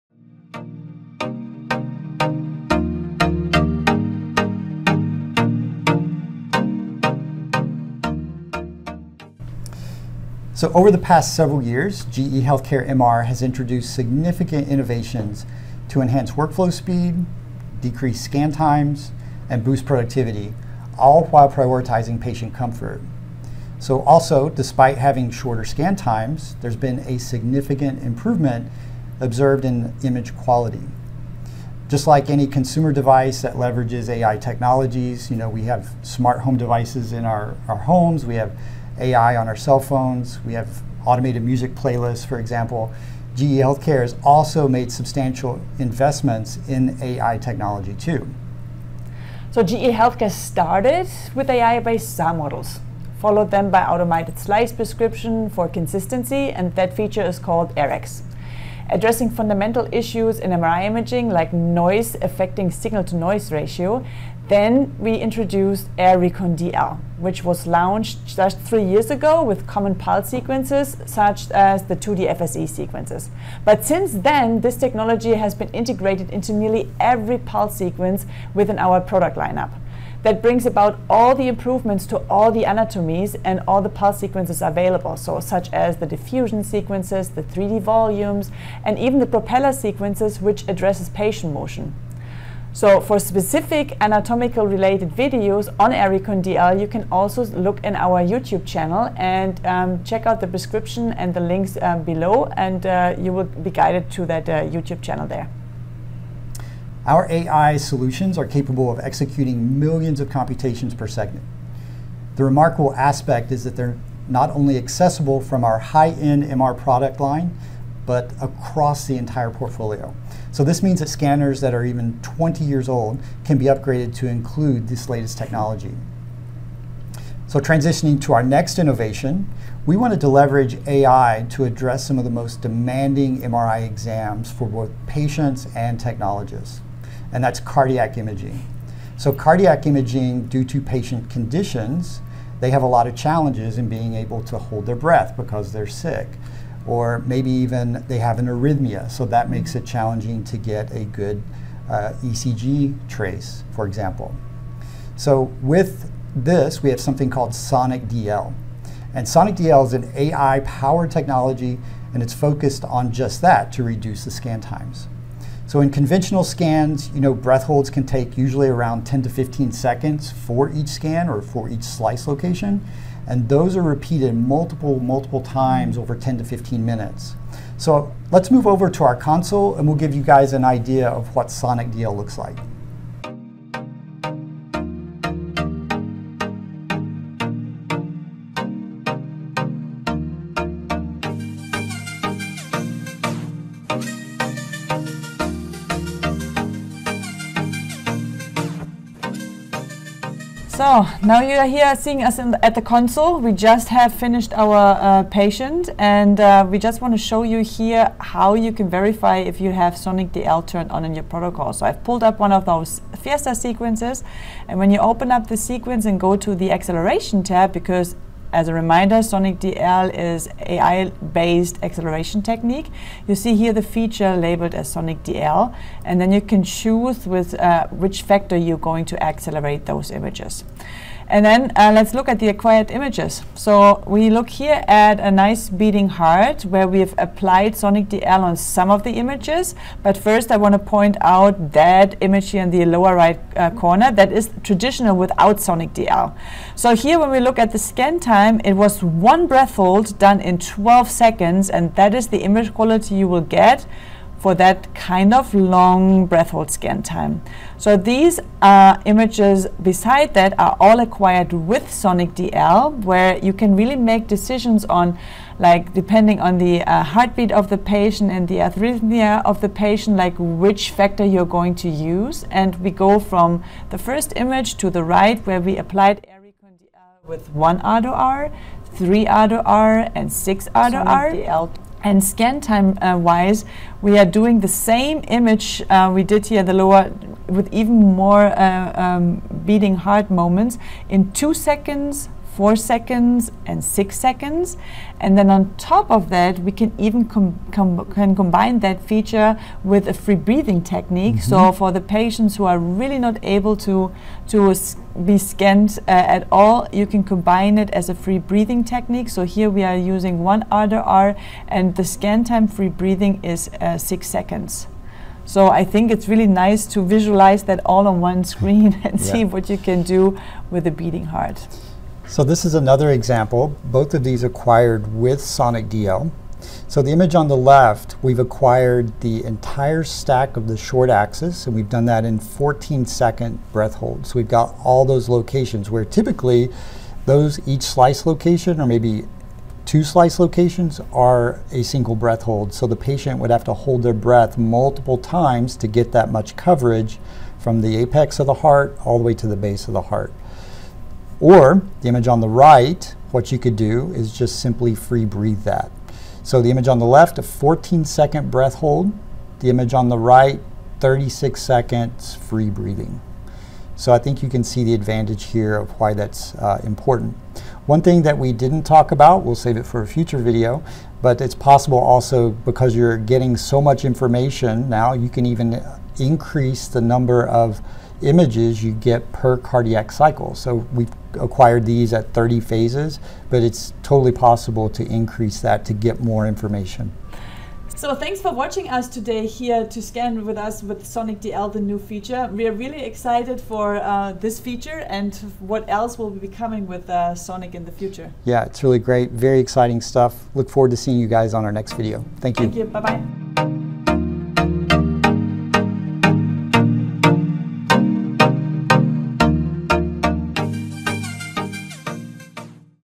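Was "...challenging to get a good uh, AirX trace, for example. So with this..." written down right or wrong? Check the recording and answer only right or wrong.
wrong.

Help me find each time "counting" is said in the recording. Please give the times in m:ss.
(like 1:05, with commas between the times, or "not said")
not said.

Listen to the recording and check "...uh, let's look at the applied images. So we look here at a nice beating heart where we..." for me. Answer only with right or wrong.
wrong.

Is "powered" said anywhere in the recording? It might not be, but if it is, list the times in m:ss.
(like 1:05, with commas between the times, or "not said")
2:40.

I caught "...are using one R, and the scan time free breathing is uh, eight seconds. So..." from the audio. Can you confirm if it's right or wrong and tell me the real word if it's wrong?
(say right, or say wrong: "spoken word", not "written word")
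wrong: "six", not "eight".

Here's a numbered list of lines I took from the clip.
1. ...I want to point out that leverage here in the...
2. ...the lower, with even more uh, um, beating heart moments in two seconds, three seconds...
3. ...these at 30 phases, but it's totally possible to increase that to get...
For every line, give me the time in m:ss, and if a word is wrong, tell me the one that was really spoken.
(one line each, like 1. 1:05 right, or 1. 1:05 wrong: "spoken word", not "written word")
1. 4:00 wrong: "image", not "leverage"
2. 4:46 wrong: "four", not "three"
3. 6:21 right.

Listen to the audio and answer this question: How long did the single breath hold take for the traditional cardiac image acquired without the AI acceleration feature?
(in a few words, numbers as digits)
12 seconds.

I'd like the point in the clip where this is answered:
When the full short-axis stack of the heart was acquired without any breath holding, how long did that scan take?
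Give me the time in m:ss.
6:00.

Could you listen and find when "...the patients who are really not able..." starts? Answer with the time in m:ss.
5:01.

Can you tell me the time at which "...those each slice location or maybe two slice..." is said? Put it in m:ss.
5:37.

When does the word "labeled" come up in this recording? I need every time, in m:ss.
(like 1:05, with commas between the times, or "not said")
3:44.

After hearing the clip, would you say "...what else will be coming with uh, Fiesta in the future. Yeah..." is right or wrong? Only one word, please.
wrong.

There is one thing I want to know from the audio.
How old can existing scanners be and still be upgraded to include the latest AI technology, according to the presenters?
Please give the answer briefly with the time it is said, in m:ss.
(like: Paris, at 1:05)
20 years, at 2:02.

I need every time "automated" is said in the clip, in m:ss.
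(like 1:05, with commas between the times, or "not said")
0:41, 0:53.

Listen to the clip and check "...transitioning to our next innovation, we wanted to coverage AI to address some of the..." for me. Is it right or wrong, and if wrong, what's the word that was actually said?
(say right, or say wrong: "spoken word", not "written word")
wrong: "leverage", not "coverage".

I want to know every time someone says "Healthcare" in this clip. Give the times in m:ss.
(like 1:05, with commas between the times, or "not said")
0:12, 0:43, 0:49.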